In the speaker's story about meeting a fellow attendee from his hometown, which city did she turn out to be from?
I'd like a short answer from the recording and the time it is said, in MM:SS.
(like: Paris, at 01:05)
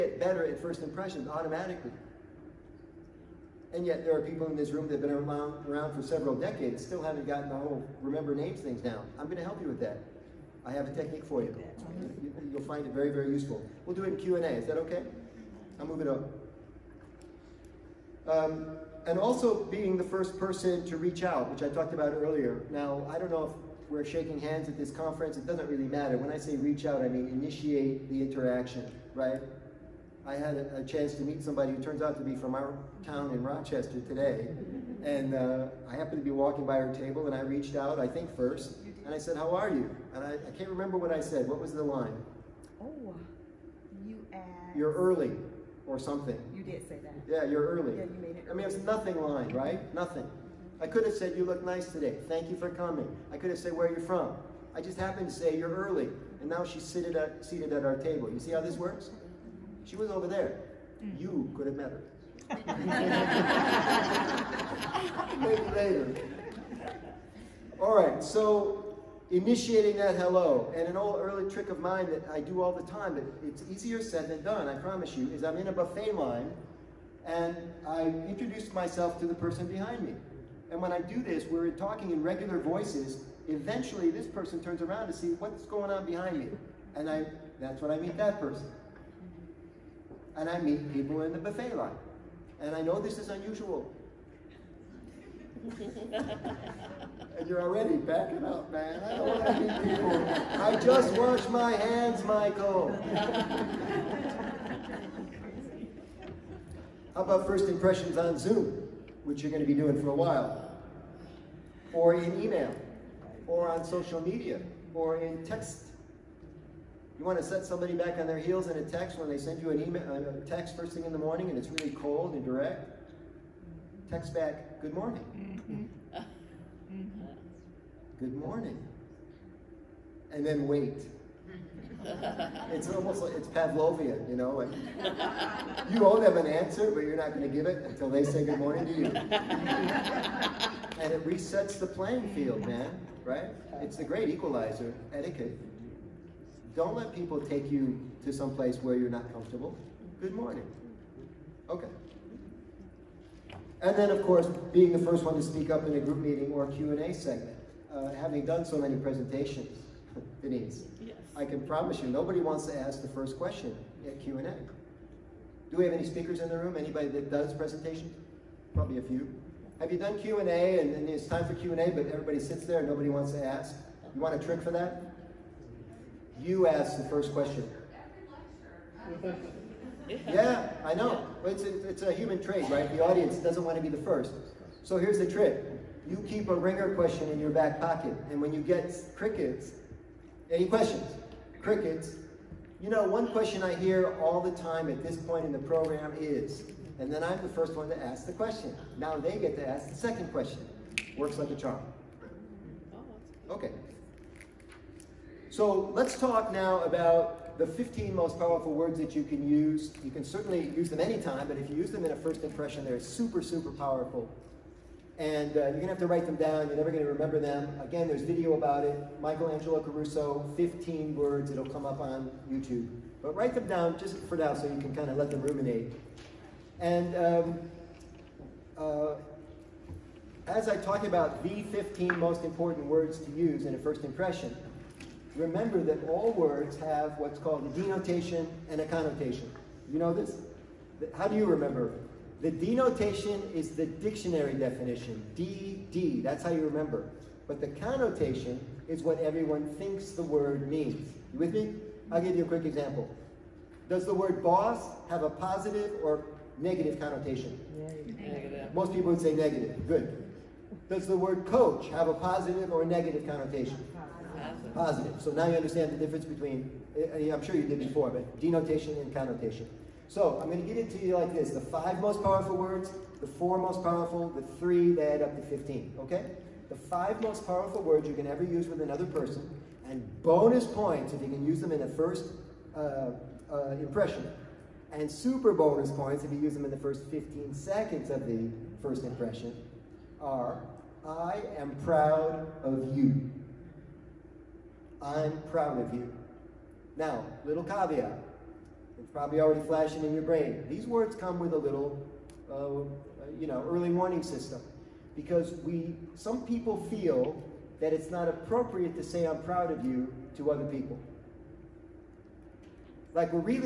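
Rochester, at 00:33.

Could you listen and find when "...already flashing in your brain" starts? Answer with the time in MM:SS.
04:59.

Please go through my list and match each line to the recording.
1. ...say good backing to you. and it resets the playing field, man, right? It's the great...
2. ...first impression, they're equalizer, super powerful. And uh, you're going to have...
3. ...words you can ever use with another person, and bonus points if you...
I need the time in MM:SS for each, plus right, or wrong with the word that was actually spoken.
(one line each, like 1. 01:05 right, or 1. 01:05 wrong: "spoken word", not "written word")
1. 02:18 wrong: "morning", not "backing"
2. 03:32 wrong: "super", not "equalizer"
3. 04:37 right.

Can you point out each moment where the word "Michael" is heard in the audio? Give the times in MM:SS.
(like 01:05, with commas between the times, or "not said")
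01:42, 03:39.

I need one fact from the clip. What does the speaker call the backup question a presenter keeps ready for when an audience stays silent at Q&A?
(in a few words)
A ringer question.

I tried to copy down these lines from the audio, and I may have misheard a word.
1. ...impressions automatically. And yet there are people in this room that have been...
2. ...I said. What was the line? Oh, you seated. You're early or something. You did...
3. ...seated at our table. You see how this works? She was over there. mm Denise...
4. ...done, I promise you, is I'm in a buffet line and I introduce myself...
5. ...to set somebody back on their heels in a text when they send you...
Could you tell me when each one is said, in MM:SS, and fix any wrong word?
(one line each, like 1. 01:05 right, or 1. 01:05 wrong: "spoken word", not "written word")
1. 00:00 right
2. 00:41 wrong: "asked", not "seated"
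3. 00:57 wrong: "You", not "Denise"
4. 01:14 right
5. 01:57 right.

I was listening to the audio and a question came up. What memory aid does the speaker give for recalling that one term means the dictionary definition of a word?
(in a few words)
DD.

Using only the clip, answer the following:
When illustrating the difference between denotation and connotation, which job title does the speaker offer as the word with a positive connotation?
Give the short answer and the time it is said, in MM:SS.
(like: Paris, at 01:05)
Coach, at 04:21.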